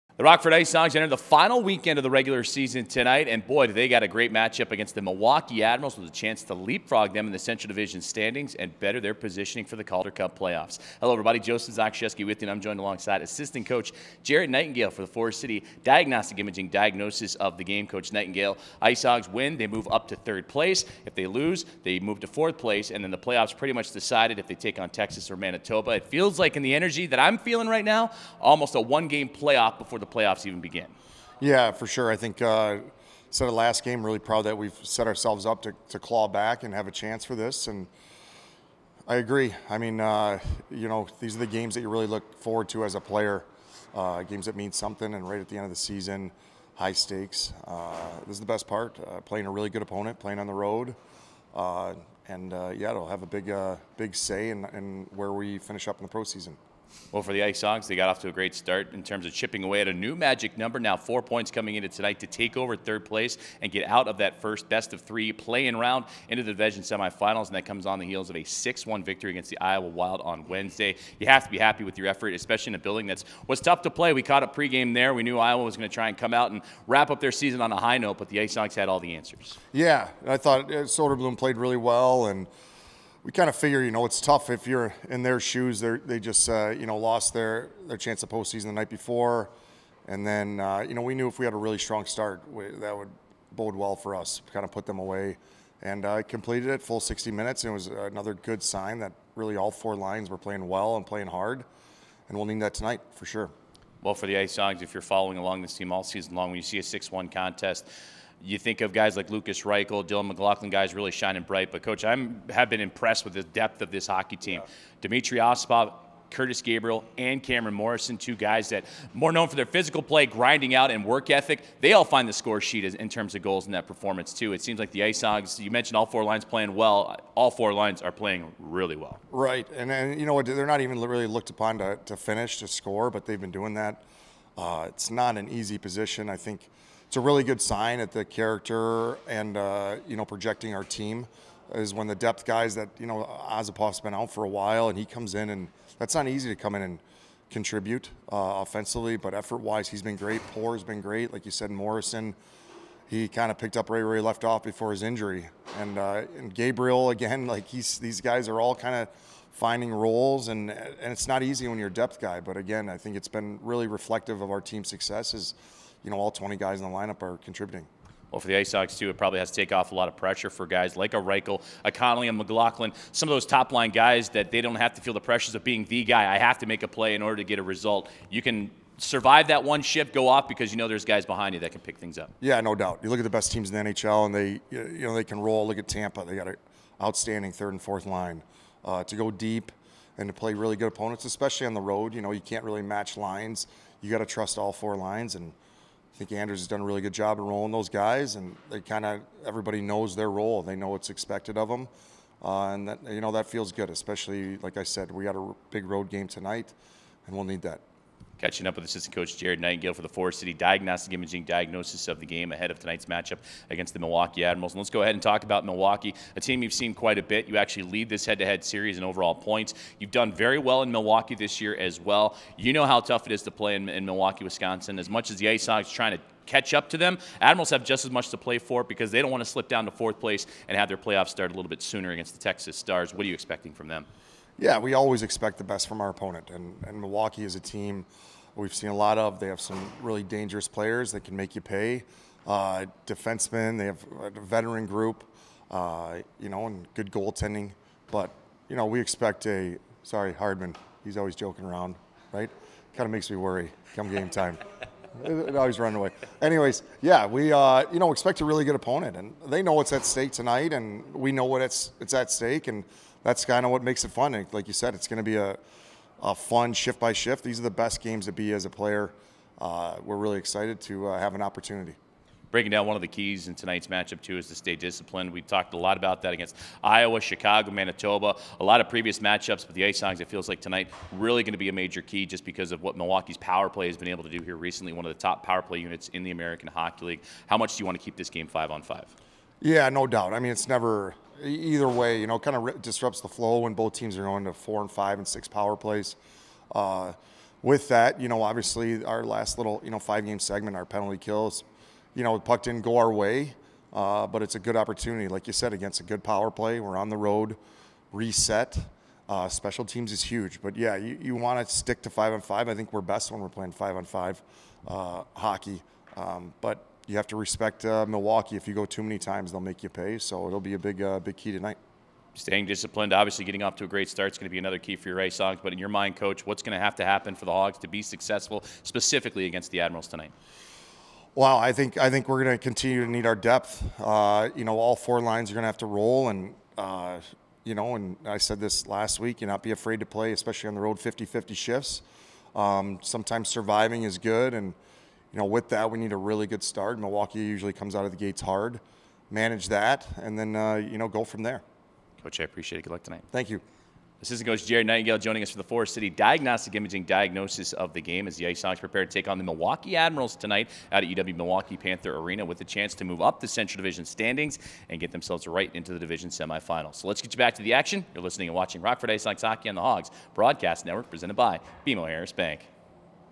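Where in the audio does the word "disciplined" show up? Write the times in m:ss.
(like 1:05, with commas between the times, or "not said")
4:34, 5:22.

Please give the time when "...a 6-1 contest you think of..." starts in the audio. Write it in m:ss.
1:46.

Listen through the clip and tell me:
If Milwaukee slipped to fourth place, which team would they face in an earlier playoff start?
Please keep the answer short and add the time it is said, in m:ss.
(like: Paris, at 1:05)
Texas Stars, at 3:52.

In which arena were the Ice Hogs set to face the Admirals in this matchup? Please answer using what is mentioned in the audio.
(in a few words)
UW Milwaukee Panther Arena.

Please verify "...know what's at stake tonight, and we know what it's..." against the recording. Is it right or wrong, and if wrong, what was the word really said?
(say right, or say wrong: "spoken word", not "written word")
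right.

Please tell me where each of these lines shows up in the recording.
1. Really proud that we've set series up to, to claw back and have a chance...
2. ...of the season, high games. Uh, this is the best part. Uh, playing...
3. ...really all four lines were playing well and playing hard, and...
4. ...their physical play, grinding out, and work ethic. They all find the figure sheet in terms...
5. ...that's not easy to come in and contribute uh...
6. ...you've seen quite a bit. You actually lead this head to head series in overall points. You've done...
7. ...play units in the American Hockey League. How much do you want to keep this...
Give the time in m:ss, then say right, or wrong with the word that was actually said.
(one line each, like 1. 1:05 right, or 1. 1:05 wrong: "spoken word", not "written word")
1. 0:34 wrong: "ourselves", not "series"
2. 0:45 wrong: "stakes", not "games"
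3. 1:39 right
4. 1:59 wrong: "score", not "figure"
5. 2:25 right
6. 3:36 right
7. 4:45 right.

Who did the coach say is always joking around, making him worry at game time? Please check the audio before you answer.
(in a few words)
Hardman.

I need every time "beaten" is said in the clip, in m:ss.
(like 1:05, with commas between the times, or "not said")
not said.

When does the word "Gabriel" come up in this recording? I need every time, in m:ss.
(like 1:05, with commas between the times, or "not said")
1:56, 2:36.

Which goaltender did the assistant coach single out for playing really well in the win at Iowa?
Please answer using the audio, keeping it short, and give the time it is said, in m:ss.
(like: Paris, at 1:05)
Soderblom, at 1:20.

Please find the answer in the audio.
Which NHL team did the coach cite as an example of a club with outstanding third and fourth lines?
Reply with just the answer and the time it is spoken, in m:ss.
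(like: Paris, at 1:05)
Tampa, at 3:05.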